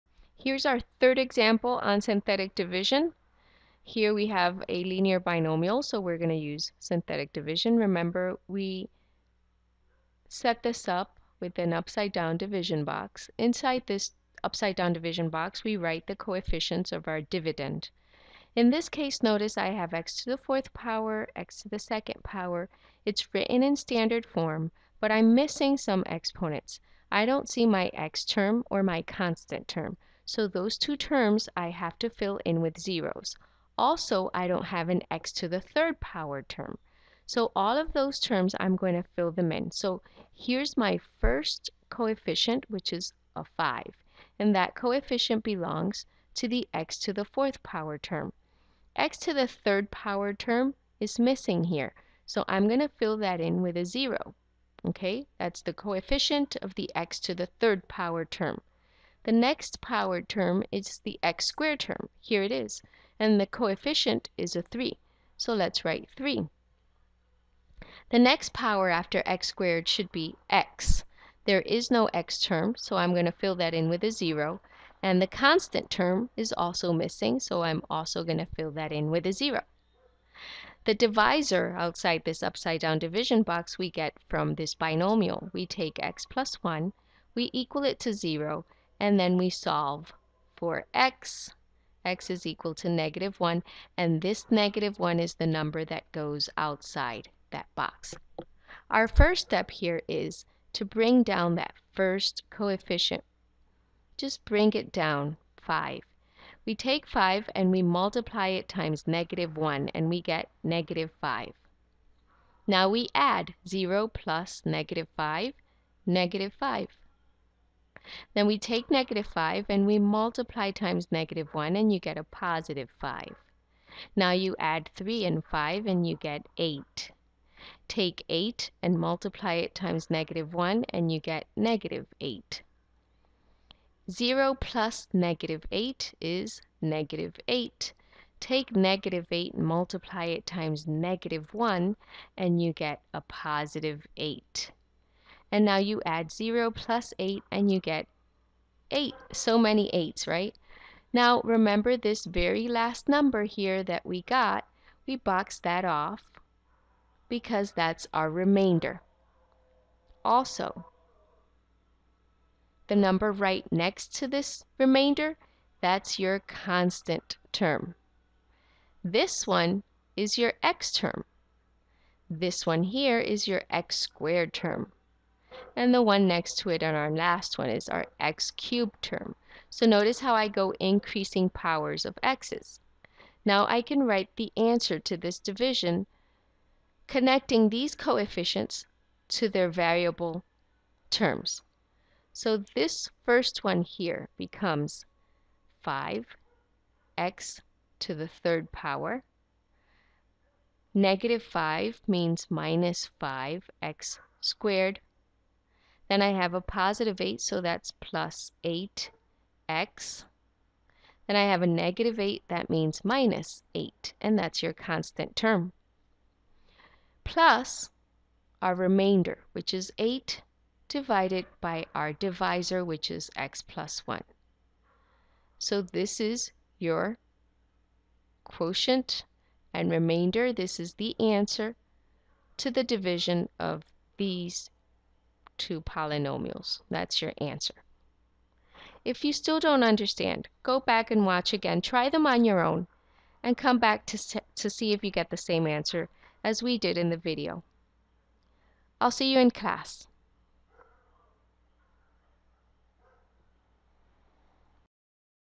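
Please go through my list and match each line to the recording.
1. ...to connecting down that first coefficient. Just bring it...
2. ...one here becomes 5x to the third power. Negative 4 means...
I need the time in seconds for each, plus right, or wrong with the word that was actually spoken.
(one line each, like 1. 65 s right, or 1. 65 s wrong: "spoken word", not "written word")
1. 100 s wrong: "bring", not "connecting"
2. 193 s wrong: "5", not "4".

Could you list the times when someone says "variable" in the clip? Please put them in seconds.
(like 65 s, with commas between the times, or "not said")
189 s.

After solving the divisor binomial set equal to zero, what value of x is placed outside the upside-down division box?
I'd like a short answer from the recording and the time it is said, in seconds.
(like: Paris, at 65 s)
-1, at 92 s.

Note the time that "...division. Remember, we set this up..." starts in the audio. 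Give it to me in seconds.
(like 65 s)
7 s.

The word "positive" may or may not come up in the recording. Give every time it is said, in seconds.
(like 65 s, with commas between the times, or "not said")
122 s, 143 s, 206 s.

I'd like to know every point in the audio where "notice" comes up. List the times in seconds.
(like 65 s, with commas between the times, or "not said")
19 s, 179 s.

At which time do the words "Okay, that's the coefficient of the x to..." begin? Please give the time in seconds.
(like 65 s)
54 s.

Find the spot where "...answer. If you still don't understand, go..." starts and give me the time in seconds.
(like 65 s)
237 s.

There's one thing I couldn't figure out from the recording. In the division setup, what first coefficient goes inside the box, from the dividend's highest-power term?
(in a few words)
5.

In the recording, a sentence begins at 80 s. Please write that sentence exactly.
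The divisor outside this upside down division box we get from this binomial.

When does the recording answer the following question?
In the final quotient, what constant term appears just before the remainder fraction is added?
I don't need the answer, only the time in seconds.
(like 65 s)
213 s.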